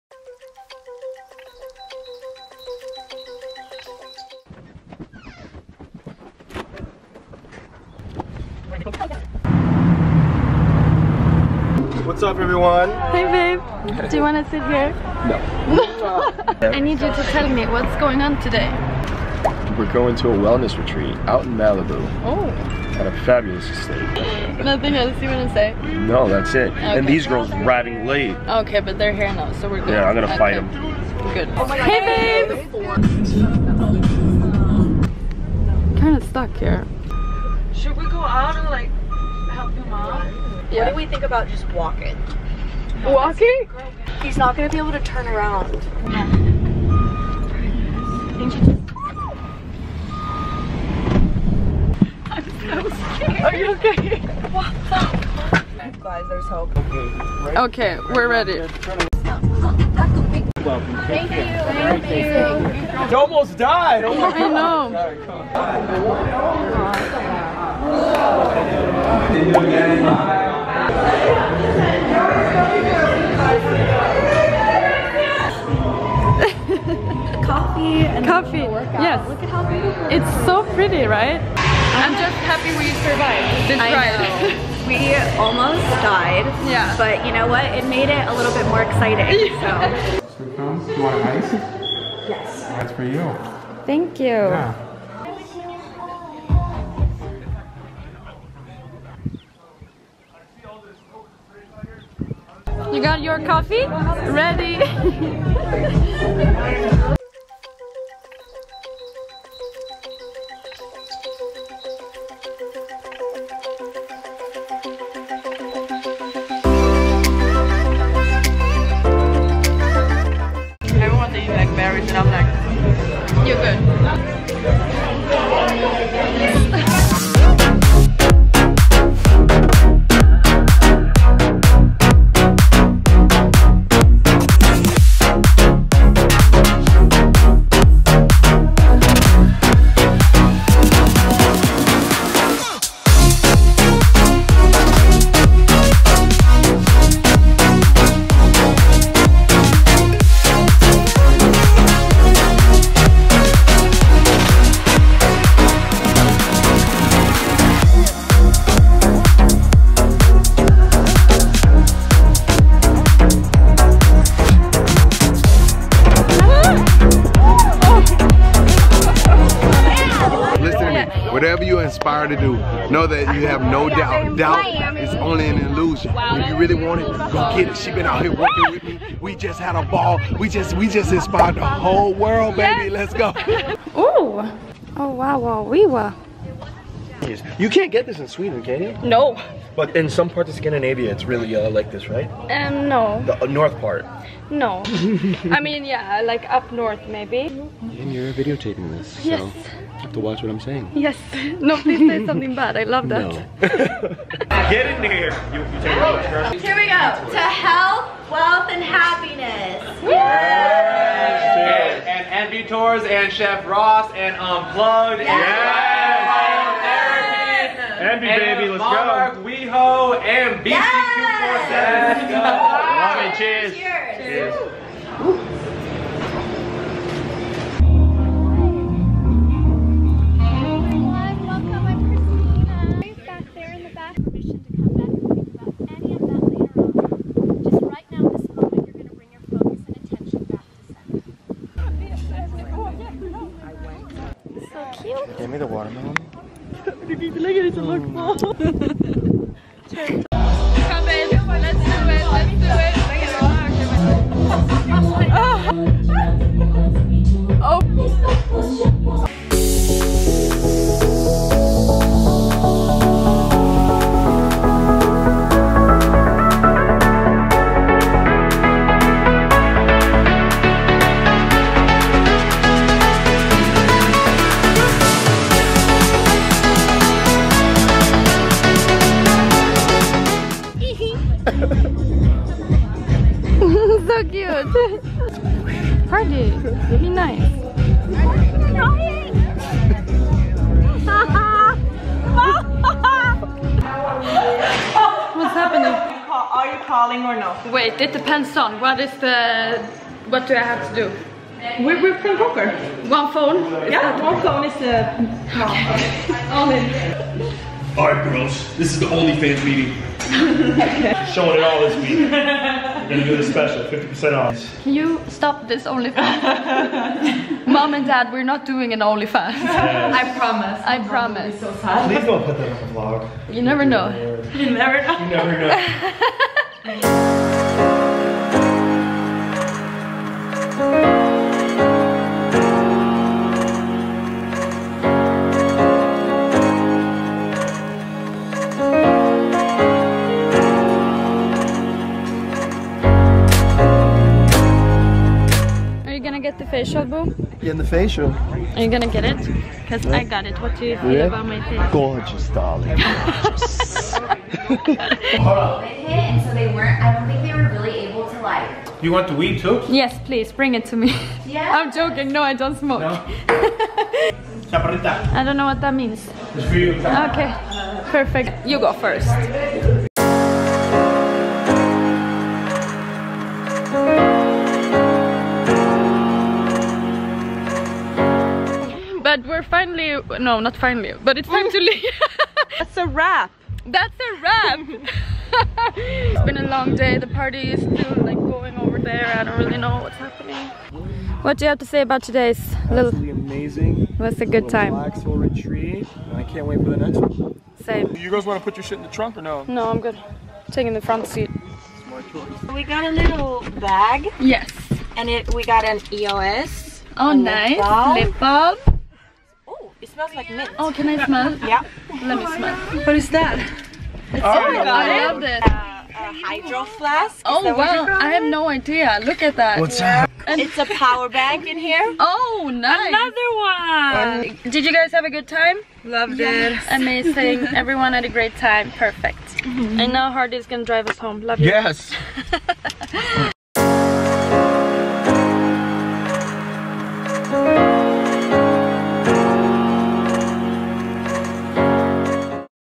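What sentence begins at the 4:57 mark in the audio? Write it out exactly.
Wait, it depends on what is the...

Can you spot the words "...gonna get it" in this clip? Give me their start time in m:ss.
5:48.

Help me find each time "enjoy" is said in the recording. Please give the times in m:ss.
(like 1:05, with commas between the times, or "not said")
not said.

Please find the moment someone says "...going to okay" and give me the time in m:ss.
0:30.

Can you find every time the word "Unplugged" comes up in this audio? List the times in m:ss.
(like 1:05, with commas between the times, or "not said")
3:34.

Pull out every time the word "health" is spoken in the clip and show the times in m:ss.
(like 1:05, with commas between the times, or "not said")
3:27.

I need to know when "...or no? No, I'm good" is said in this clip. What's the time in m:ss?
6:39.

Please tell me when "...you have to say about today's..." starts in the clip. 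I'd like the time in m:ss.
6:31.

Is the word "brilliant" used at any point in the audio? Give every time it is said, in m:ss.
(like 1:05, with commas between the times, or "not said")
not said.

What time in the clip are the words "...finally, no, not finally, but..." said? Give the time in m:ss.
6:19.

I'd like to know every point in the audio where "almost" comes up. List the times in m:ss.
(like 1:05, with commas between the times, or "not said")
1:03, 1:25.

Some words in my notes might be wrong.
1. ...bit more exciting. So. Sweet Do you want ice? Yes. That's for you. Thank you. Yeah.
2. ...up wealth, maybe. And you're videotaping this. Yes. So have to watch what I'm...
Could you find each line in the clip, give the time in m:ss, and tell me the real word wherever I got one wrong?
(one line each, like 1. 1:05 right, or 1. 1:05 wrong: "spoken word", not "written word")
1. 1:28 right
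2. 3:16 wrong: "north", not "wealth".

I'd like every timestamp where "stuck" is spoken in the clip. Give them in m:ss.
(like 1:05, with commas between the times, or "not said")
0:36.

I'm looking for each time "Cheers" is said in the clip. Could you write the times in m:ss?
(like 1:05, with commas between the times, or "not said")
3:31.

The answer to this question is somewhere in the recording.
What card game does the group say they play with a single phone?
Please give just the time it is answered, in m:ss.
5:02.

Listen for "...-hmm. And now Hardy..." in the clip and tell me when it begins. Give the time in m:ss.
7:09.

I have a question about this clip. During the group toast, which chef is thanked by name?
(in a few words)
Chef Ross.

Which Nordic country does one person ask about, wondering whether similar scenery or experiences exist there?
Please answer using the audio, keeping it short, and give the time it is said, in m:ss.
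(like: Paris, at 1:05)
Sweden, at 3:08.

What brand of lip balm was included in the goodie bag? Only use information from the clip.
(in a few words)
EOS.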